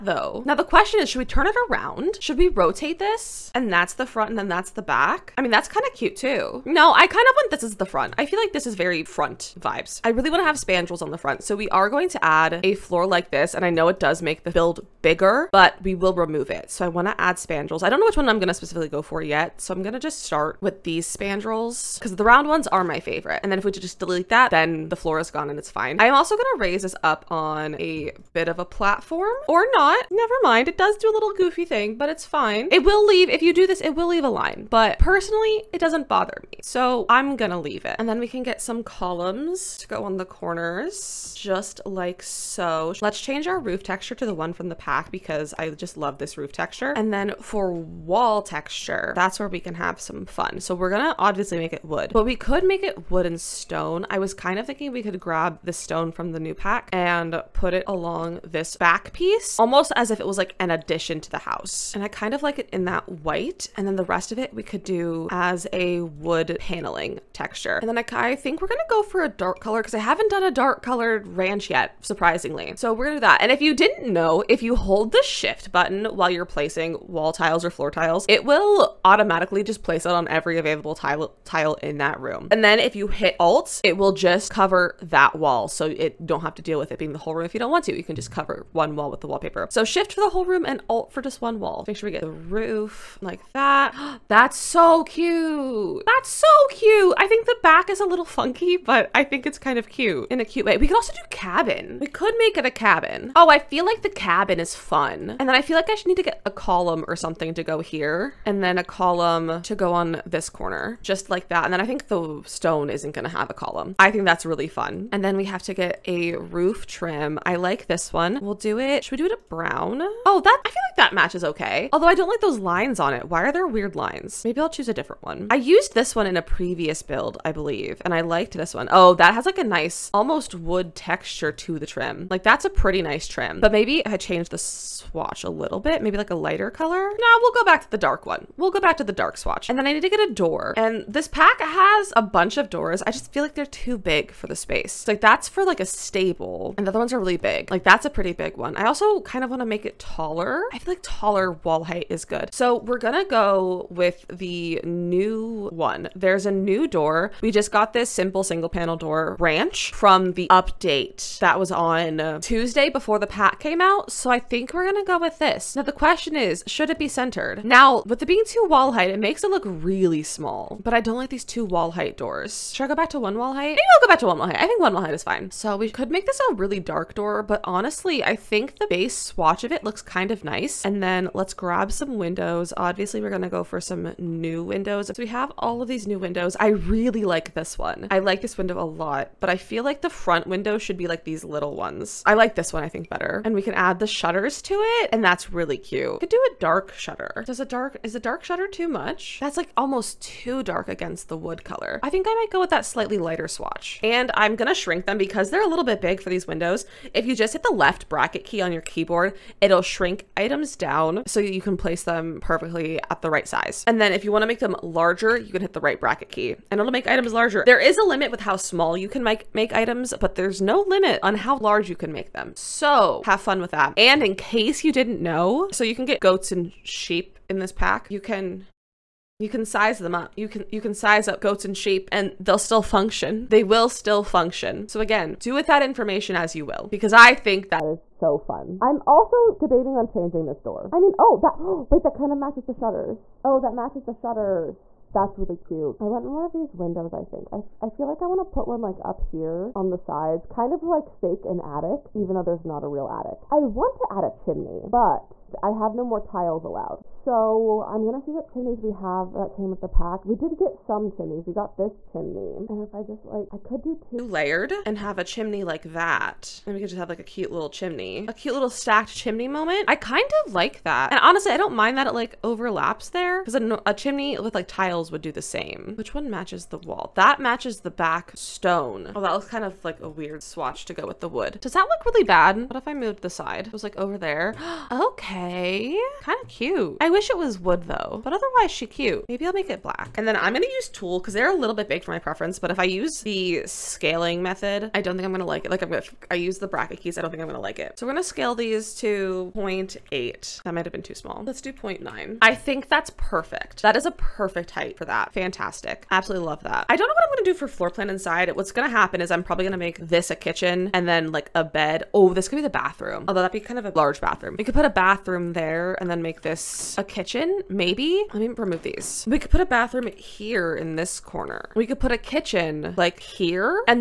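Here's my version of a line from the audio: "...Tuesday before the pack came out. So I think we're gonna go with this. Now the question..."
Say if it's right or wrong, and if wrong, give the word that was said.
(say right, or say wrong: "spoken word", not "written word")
right.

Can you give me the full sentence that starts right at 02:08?
Oh, that has like a nice almost wood texture to the trim.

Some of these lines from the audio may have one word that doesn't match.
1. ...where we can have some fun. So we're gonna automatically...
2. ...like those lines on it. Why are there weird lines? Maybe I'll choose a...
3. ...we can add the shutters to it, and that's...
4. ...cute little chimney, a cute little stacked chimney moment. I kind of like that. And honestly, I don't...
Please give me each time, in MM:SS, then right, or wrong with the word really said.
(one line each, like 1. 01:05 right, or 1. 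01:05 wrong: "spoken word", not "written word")
1. 00:49 wrong: "obviously", not "automatically"
2. 02:02 right
3. 03:13 right
4. 04:27 right.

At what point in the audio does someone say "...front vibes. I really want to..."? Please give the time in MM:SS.
00:09.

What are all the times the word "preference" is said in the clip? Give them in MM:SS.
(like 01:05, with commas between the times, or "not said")
04:52.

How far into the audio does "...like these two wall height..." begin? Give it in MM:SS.
02:51.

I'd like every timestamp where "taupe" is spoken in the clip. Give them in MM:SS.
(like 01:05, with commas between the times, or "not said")
not said.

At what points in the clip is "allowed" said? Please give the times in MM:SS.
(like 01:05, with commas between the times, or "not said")
04:16.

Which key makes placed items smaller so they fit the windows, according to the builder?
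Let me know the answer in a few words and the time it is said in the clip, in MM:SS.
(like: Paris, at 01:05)
Left bracket key, at 03:27.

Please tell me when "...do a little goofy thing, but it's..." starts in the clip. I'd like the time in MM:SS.
00:30.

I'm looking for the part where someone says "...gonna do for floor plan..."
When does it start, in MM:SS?
05:07.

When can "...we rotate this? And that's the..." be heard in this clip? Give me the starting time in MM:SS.
00:02.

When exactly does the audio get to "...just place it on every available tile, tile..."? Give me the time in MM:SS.
01:19.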